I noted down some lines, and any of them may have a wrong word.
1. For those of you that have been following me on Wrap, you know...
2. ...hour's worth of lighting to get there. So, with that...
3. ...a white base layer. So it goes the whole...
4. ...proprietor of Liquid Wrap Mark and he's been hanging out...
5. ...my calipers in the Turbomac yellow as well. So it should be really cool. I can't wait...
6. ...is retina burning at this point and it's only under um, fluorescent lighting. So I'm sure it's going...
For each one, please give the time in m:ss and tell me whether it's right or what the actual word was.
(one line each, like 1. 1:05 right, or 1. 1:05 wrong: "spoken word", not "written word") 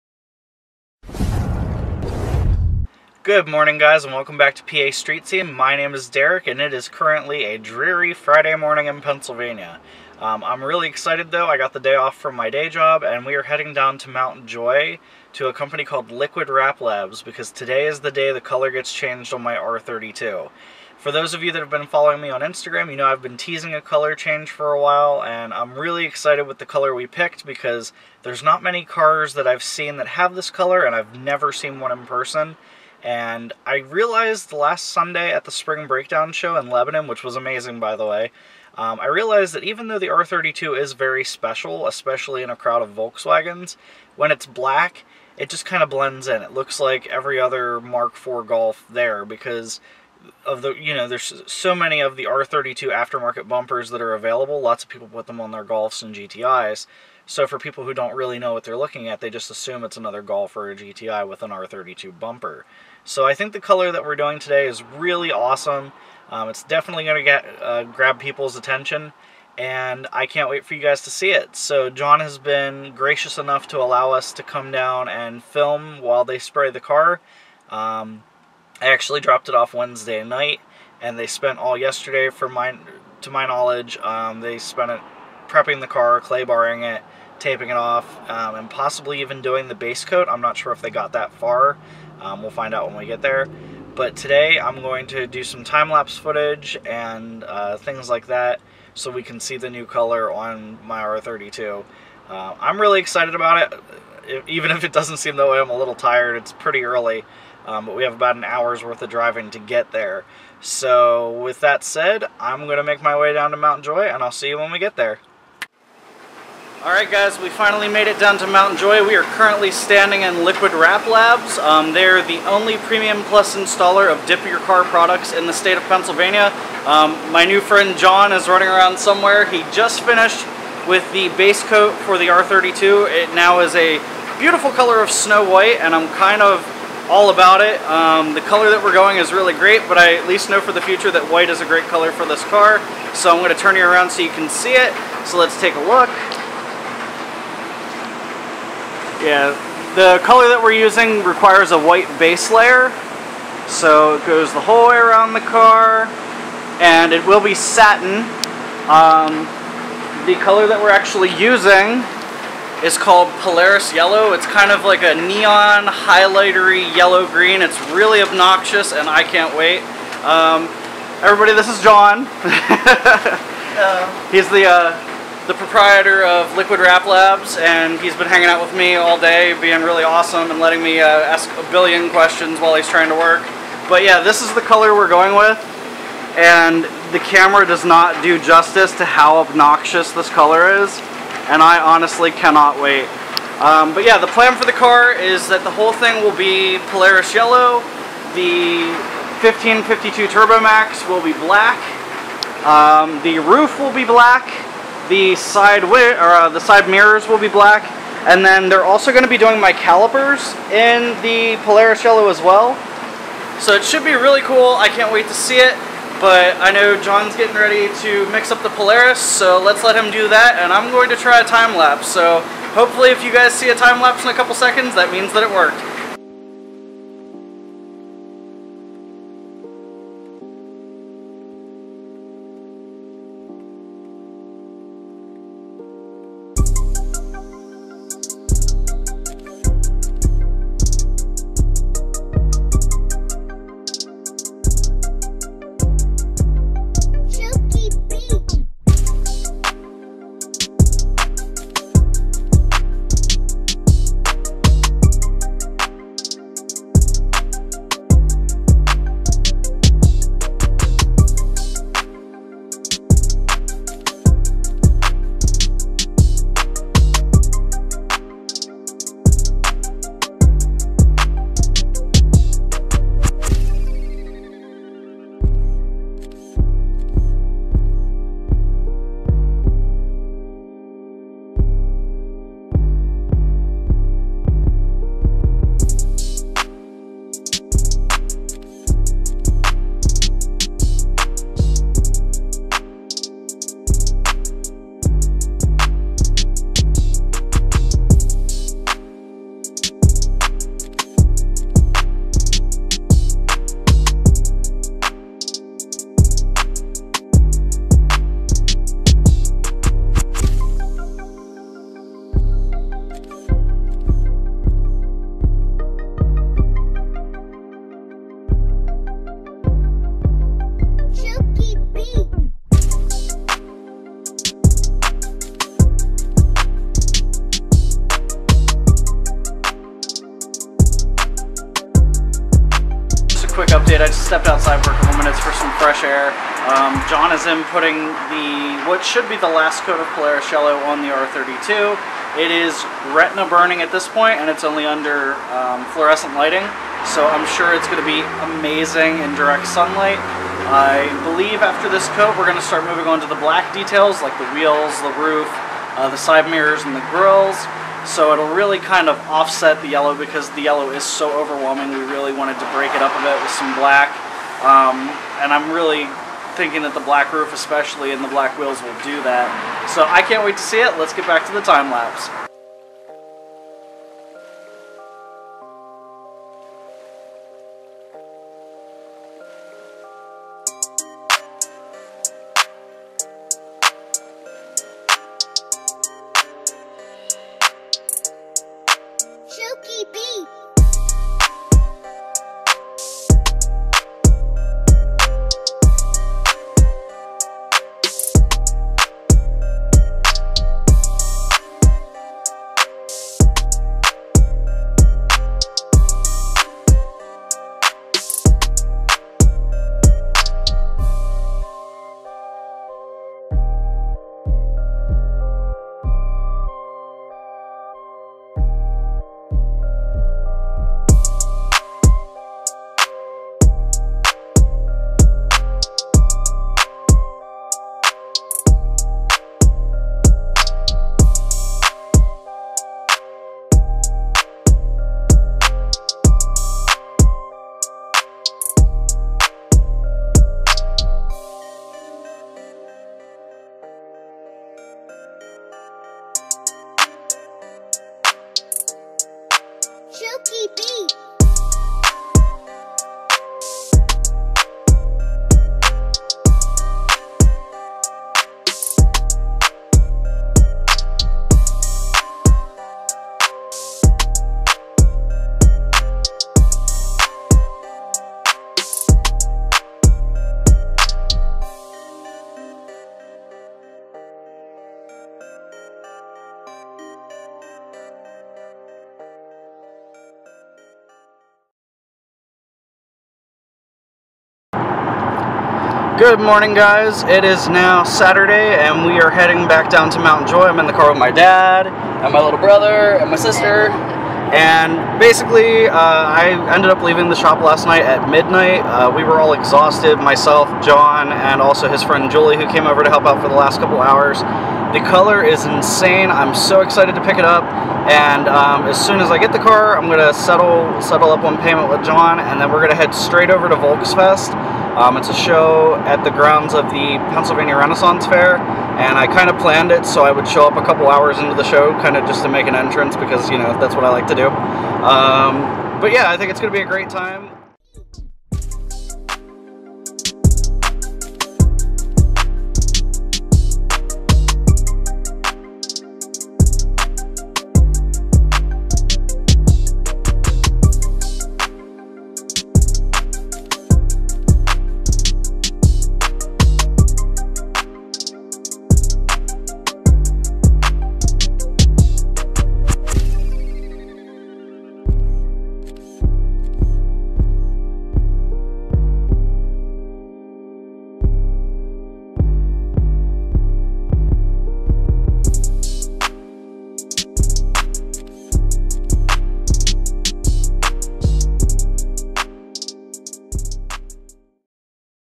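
1. 0:20 wrong: "Instagram", not "Wrap"
2. 1:48 wrong: "driving", not "lighting"
3. 2:31 right
4. 2:55 wrong: "Labs", not "Mark"
5. 3:29 wrong: "Polaris", not "Turbomac"
6. 5:42 right.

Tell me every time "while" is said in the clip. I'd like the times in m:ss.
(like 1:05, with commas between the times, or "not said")
0:24, 1:16, 3:02.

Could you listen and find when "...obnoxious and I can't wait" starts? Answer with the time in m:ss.
2:48.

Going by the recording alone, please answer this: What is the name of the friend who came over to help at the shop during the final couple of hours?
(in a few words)
Julie.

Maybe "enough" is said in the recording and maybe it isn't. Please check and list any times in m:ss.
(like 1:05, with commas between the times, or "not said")
1:13.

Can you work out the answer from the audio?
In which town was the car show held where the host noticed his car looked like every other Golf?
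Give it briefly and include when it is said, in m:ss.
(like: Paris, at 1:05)
Lebanon, at 0:36.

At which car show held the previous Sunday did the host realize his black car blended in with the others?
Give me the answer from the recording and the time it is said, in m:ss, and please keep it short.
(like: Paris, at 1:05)
Spring Breakdown, at 0:35.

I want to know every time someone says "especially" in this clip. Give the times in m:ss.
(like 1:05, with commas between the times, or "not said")
0:41, 6:07.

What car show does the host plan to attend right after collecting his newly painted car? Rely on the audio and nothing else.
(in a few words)
Volksfest.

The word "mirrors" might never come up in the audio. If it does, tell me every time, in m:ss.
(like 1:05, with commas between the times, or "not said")
3:26, 5:56.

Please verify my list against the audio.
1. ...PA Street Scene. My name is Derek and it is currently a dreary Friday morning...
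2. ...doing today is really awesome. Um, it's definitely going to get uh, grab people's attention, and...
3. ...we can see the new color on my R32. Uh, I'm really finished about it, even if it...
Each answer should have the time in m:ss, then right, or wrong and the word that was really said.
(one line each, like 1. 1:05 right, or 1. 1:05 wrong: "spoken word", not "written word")
1. 0:04 right
2. 1:04 right
3. 1:39 wrong: "excited", not "finished".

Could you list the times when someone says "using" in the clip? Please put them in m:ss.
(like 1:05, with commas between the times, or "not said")
2:30, 2:41.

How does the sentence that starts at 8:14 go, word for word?
And basically, uh, I ended up leaving the shop last night at midnight.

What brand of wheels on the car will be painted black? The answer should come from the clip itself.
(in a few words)
Fifteen52.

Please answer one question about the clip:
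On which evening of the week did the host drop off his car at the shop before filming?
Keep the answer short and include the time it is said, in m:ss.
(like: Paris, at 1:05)
Wednesday, at 1:19.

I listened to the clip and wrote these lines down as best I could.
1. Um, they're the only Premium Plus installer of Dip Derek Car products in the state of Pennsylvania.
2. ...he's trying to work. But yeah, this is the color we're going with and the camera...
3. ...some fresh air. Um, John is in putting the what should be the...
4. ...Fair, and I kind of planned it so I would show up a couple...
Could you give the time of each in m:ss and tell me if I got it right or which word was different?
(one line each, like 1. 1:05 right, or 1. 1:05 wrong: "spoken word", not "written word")
1. 2:01 wrong: "Your", not "Derek"
2. 3:02 right
3. 5:35 right
4. 8:38 right.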